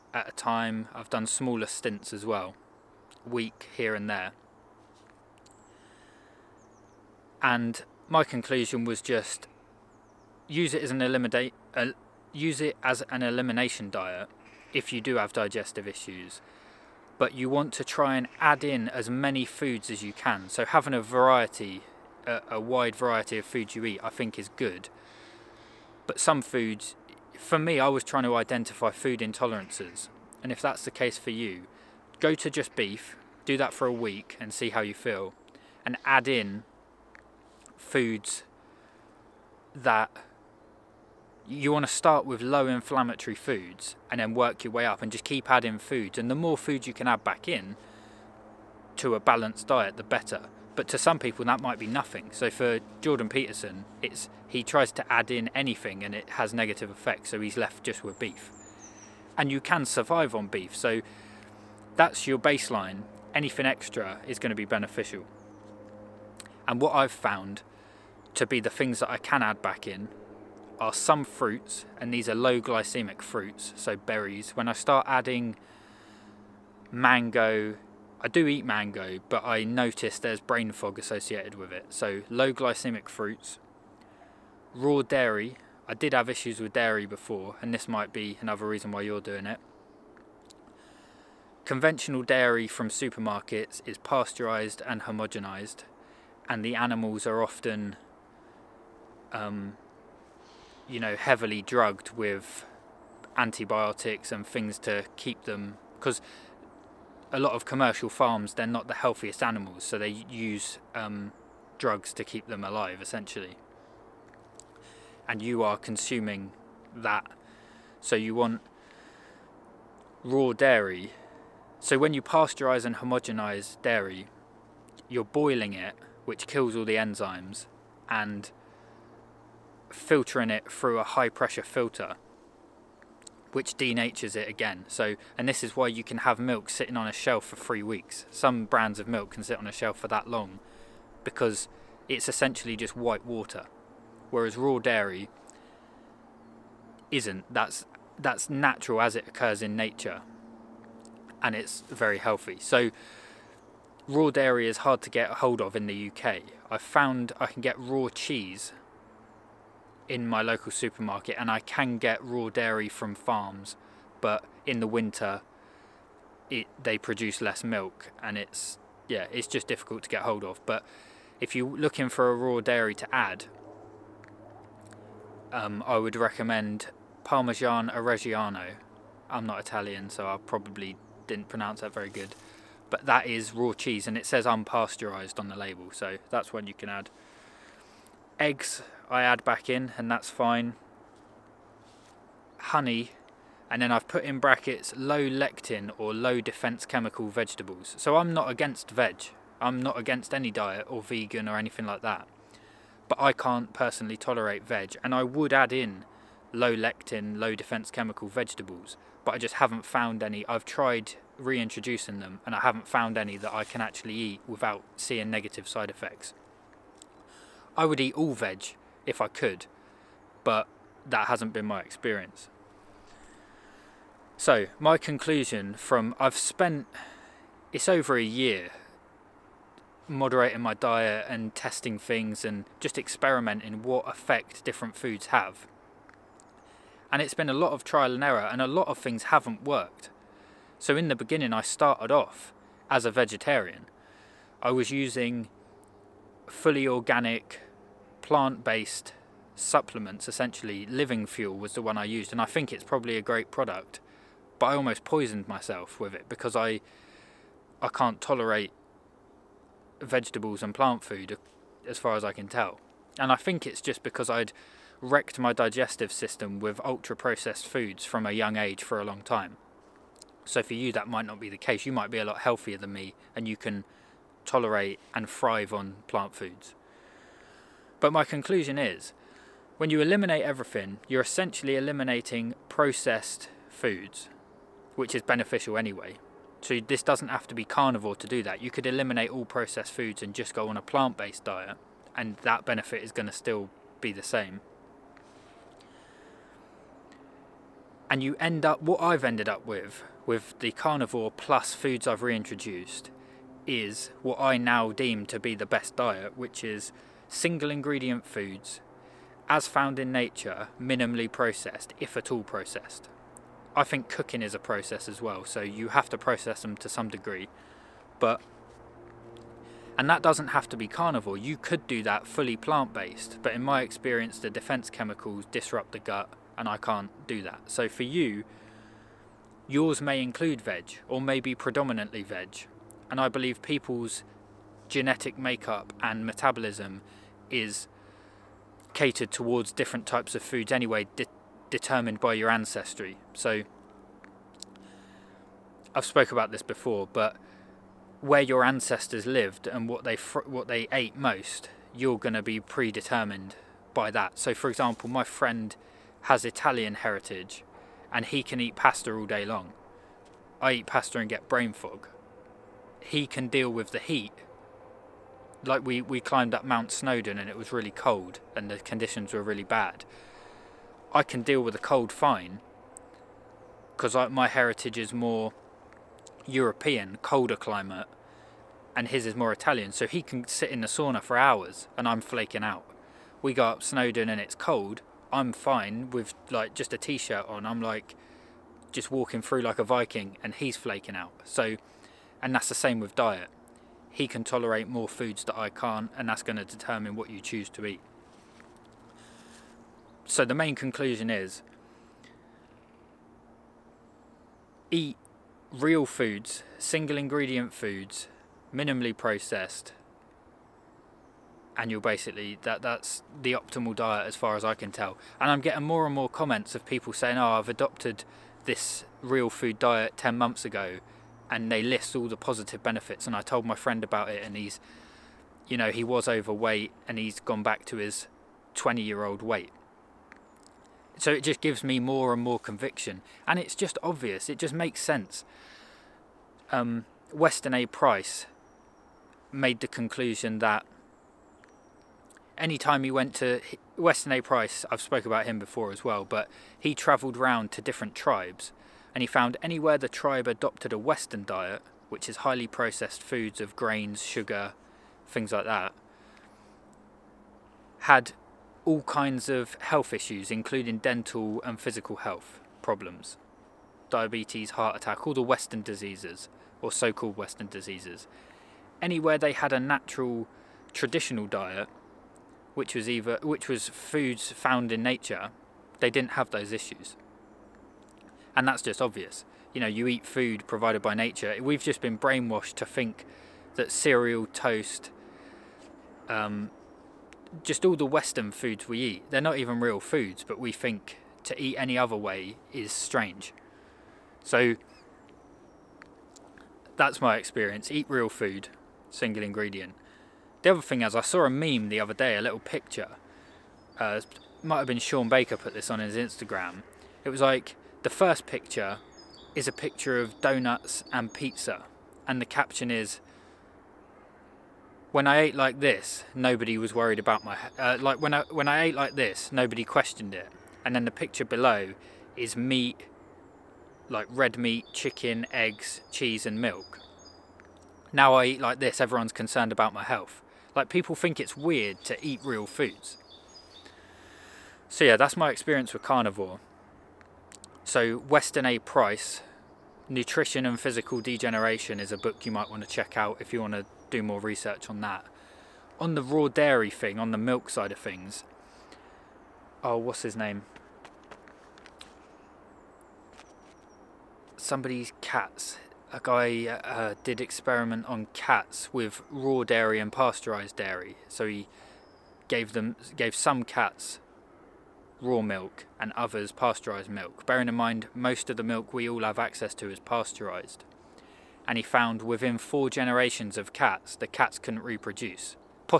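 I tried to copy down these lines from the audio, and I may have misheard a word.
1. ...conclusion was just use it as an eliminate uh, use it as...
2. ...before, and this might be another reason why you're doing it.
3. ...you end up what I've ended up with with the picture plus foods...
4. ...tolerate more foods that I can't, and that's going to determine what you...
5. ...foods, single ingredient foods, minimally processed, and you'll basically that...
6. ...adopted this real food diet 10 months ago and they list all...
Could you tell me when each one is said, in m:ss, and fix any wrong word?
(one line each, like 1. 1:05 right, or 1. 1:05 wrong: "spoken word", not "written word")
1. 0:08 right
2. 1:27 right
3. 4:58 wrong: "carnivore", not "picture"
4. 6:34 right
5. 6:46 right
6. 6:57 right.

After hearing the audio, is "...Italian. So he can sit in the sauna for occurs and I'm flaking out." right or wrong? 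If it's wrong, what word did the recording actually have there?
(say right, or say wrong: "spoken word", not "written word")
wrong: "hours", not "occurs".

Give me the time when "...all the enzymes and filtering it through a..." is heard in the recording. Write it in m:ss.
2:06.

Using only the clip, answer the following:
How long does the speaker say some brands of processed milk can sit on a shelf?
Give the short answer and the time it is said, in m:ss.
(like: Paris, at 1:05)
3 weeks, at 2:17.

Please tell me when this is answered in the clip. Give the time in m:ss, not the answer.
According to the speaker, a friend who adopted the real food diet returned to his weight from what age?
7:08.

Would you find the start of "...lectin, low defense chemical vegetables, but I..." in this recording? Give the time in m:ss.
3:26.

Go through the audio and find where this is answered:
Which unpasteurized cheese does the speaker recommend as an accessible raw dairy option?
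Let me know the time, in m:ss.
2:57.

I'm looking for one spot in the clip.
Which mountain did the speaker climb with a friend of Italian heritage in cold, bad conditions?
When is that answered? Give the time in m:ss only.
6:06.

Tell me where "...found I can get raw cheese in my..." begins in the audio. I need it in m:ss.
2:36.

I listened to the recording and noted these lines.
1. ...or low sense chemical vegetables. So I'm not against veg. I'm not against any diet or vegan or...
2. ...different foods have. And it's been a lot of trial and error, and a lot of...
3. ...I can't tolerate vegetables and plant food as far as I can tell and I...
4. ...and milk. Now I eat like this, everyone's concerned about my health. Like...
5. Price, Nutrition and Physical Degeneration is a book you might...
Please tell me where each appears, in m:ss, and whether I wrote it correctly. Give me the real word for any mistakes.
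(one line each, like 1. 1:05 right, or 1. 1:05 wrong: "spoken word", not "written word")
1. 3:15 wrong: "defense", not "sense"
2. 3:54 right
3. 4:17 right
4. 8:46 right
5. 8:58 right.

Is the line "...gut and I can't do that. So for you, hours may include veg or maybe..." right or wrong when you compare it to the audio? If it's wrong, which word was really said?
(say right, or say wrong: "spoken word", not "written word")
wrong: "yours", not "hours".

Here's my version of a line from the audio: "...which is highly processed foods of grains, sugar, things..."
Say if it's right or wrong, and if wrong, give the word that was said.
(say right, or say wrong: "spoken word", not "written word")
right.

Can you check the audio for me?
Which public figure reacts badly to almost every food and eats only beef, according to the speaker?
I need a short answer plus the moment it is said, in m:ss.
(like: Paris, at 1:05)
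Jordan Peterson, at 0:53.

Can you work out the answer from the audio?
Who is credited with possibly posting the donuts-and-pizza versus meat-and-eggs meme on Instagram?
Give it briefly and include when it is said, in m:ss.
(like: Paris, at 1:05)
Shawn Baker, at 8:24.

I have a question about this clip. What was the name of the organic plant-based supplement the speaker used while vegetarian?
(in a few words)
Living Fuel.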